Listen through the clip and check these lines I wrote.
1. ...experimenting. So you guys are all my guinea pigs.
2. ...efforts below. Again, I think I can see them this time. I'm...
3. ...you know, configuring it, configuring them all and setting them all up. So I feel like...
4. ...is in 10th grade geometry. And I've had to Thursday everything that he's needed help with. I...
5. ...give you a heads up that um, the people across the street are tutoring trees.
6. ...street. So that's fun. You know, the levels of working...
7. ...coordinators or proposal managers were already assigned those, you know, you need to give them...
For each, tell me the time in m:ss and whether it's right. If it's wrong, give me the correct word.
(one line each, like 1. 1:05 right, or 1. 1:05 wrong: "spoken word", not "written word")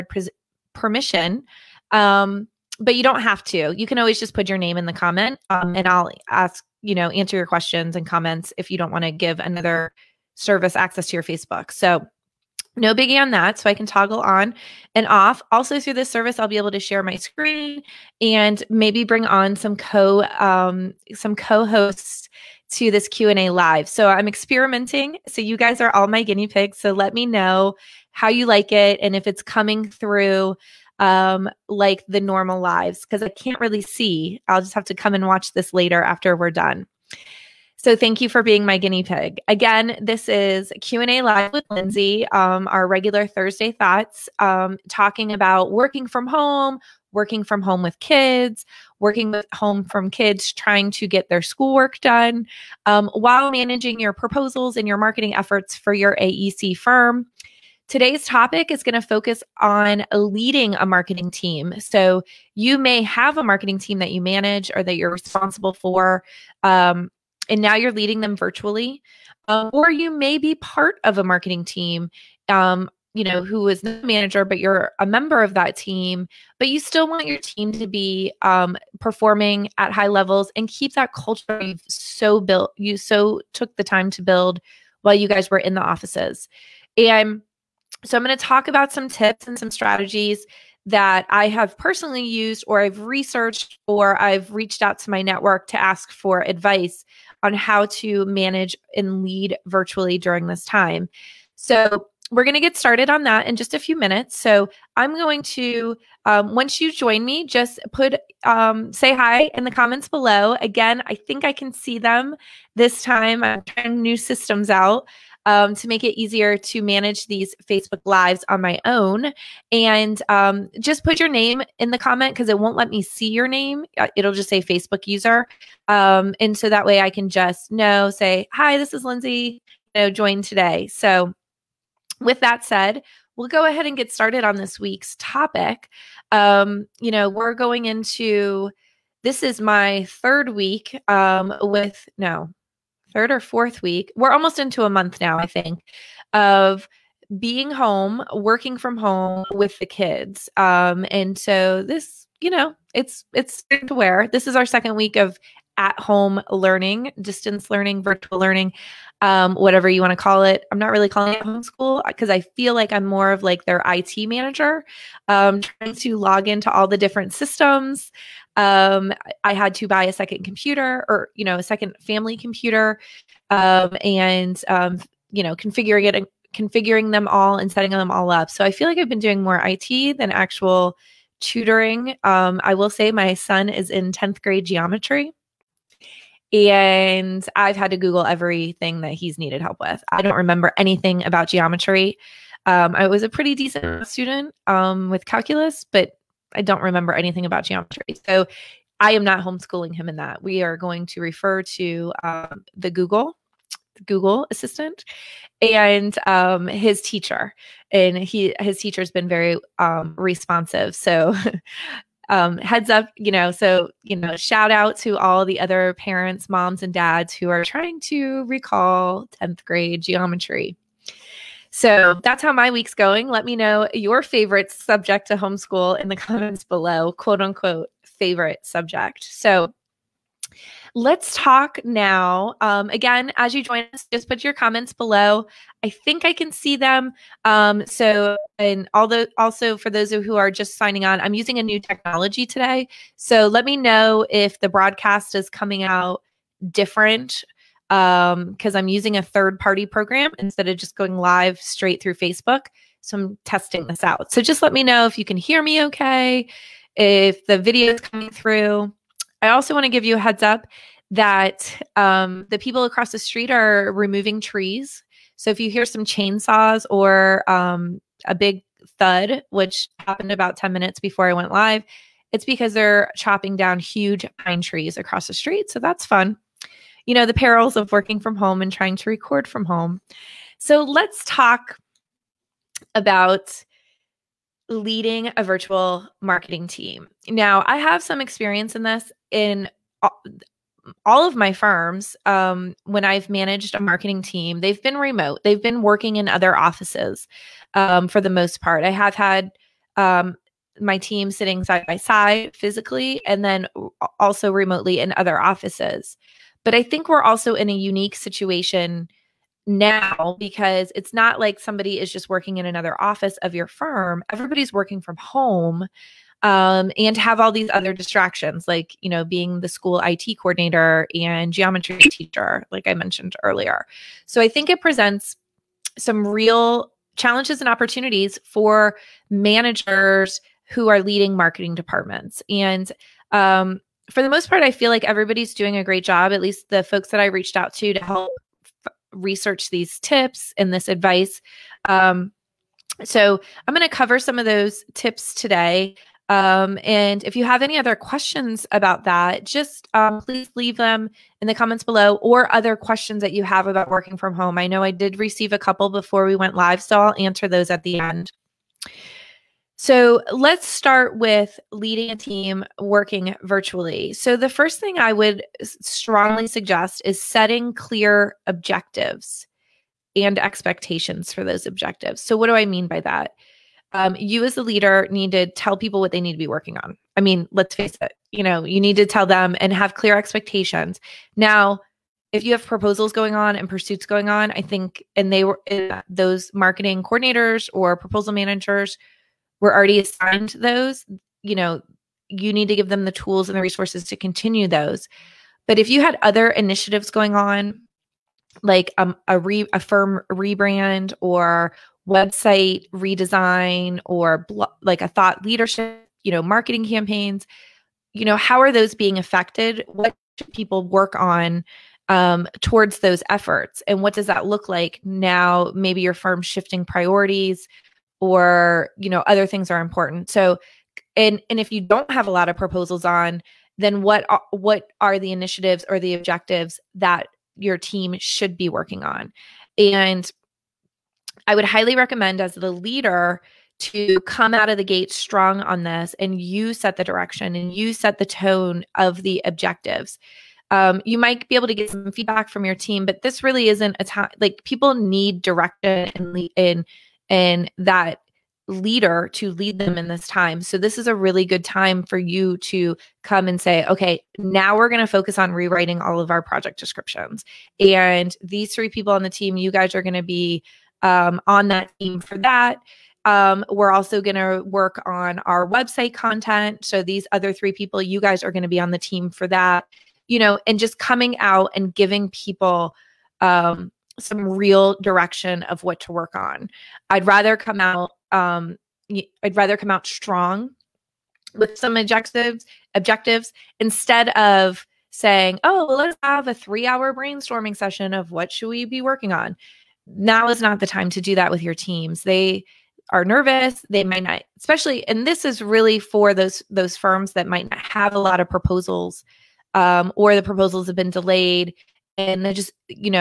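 1. 0:24 right
2. 1:49 wrong: "comments", not "efforts"
3. 2:55 right
4. 3:03 wrong: "Google", not "Thursday"
5. 4:19 wrong: "removing", not "tutoring"
6. 4:35 wrong: "perils", not "levels"
7. 6:27 right.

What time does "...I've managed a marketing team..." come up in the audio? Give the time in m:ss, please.
4:53.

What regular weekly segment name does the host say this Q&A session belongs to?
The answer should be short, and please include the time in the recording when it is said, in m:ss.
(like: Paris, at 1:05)
Thursday thoughts, at 0:43.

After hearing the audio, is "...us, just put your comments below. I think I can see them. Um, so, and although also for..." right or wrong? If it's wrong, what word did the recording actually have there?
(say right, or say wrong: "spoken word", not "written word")
right.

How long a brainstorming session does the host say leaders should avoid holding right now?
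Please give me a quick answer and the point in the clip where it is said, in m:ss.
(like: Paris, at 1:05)
3 hours, at 8:06.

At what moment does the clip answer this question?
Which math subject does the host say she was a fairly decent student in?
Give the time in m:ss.
3:15.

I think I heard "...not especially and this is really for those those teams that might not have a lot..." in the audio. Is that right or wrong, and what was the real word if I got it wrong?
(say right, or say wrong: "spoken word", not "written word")
wrong: "firms", not "teams".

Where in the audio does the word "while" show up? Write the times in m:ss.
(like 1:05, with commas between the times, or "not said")
0:53, 1:24.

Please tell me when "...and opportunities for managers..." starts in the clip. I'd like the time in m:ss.
5:27.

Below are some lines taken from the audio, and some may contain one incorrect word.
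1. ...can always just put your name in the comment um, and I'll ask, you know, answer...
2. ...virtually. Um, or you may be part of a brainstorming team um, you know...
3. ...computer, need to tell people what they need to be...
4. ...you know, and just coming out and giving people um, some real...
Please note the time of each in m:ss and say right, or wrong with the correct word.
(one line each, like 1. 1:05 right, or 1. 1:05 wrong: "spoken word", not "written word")
1. 0:03 right
2. 1:08 wrong: "marketing", not "brainstorming"
3. 6:14 wrong: "leader", not "computer"
4. 7:50 right.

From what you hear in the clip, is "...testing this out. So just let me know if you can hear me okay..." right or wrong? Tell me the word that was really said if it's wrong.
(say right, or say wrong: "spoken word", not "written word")
right.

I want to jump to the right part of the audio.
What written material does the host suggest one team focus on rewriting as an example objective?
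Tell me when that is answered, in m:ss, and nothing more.
7:36.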